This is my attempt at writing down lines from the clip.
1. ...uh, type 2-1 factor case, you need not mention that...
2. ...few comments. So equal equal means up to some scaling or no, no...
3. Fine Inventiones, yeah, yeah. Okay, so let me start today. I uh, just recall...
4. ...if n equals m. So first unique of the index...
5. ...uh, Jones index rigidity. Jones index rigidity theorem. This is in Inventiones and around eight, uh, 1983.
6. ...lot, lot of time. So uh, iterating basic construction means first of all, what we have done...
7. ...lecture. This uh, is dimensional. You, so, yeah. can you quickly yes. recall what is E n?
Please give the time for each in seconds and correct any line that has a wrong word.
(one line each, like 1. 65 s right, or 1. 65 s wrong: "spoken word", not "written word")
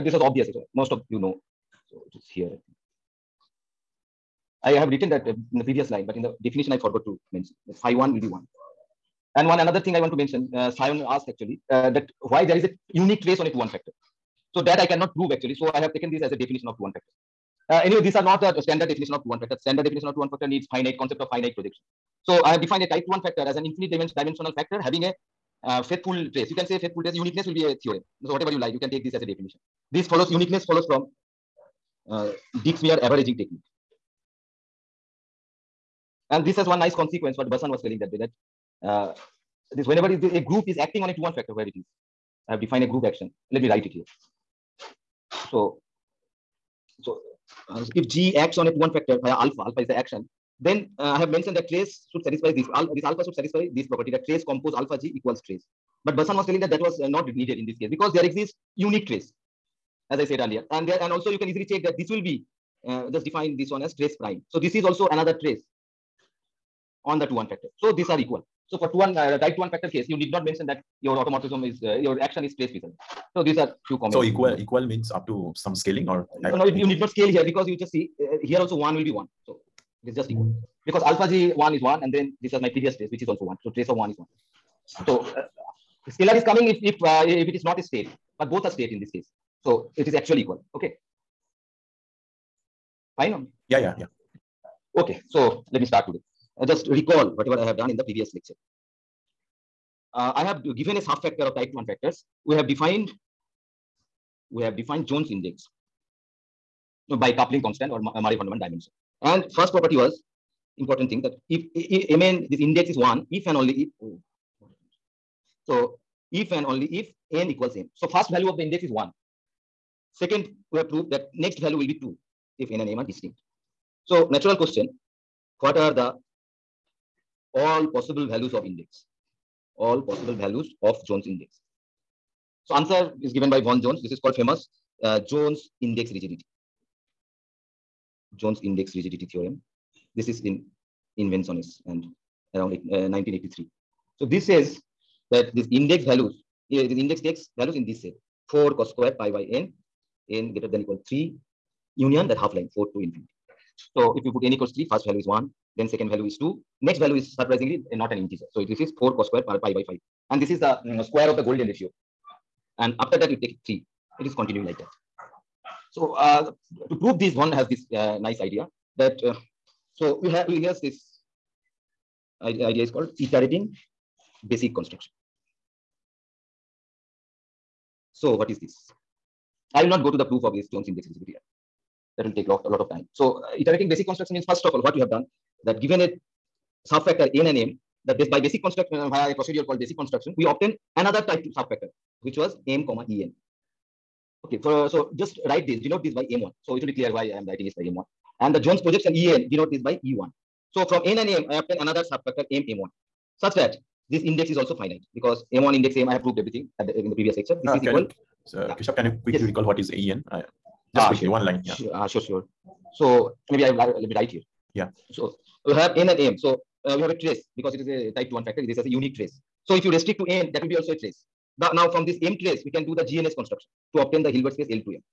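1. 69 s right
2. 73 s right
3. 93 s wrong: "Yeah", not "Inventiones"
4. 116 s wrong: "value", not "unique"
5. 135 s right
6. 182 s right
7. 207 s wrong: "equal", not "dimensional".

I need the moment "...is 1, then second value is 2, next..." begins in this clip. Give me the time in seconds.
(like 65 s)
155 s.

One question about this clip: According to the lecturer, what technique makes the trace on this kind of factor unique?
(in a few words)
averaging technique.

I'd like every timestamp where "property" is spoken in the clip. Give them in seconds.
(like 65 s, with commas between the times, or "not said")
53 s, 109 s.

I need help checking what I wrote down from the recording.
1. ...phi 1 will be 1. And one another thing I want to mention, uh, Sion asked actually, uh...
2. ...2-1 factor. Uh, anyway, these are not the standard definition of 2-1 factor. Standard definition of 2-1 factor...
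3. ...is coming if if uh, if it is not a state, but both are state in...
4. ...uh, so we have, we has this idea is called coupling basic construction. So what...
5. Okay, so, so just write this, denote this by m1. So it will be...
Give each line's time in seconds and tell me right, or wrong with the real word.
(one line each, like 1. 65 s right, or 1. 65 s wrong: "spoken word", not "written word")
1. 7 s right
2. 16 s right
3. 86 s right
4. 169 s wrong: "iterating", not "coupling"
5. 194 s right.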